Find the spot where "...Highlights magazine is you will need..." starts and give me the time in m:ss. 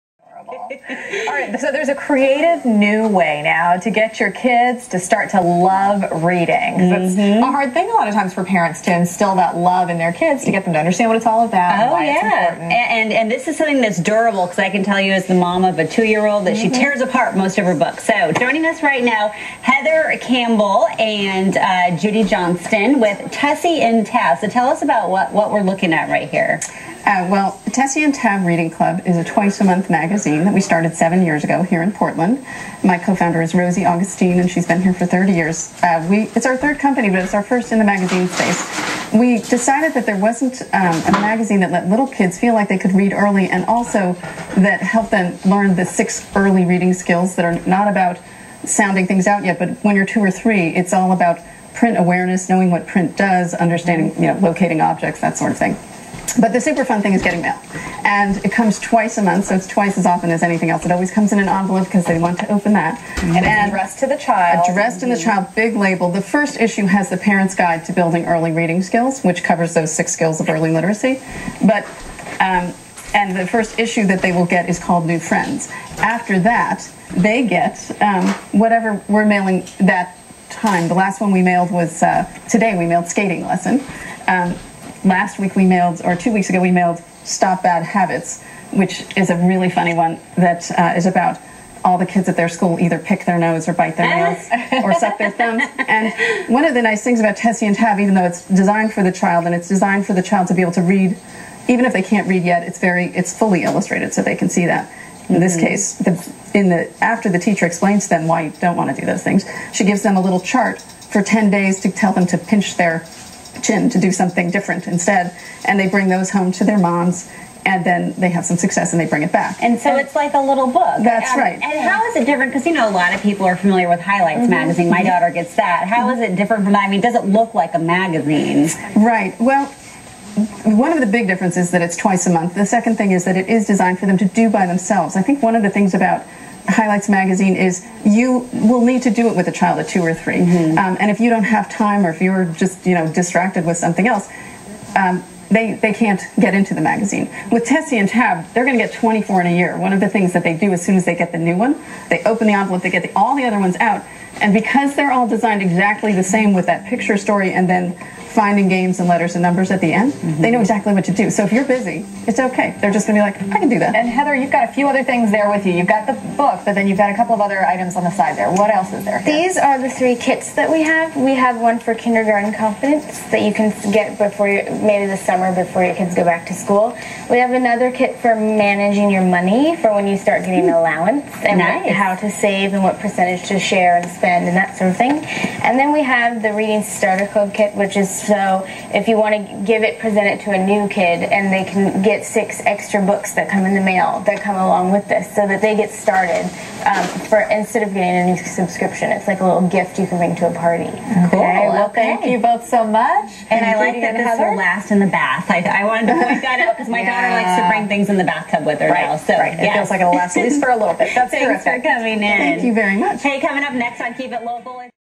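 2:16.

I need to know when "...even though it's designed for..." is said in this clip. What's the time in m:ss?
1:37.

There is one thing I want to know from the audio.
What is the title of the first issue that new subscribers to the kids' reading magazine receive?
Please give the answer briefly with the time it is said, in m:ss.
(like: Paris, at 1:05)
New Friends, at 1:15.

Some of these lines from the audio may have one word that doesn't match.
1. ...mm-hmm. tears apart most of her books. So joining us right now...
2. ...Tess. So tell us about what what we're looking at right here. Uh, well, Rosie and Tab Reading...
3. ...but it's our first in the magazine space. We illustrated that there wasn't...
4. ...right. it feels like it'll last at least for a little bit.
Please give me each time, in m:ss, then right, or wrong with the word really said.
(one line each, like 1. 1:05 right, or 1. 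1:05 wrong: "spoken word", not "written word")
1. 0:16 right
2. 0:24 wrong: "Tessy", not "Rosie"
3. 0:37 wrong: "decided", not "illustrated"
4. 3:29 right.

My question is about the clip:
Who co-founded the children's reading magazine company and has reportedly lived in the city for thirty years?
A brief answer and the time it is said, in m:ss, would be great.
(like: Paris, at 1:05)
Rosie Augustine, at 0:33.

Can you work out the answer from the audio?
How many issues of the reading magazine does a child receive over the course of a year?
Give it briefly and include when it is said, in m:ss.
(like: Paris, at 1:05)
24, at 2:28.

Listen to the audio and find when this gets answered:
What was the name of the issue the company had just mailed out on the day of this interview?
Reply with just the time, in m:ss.
1:23.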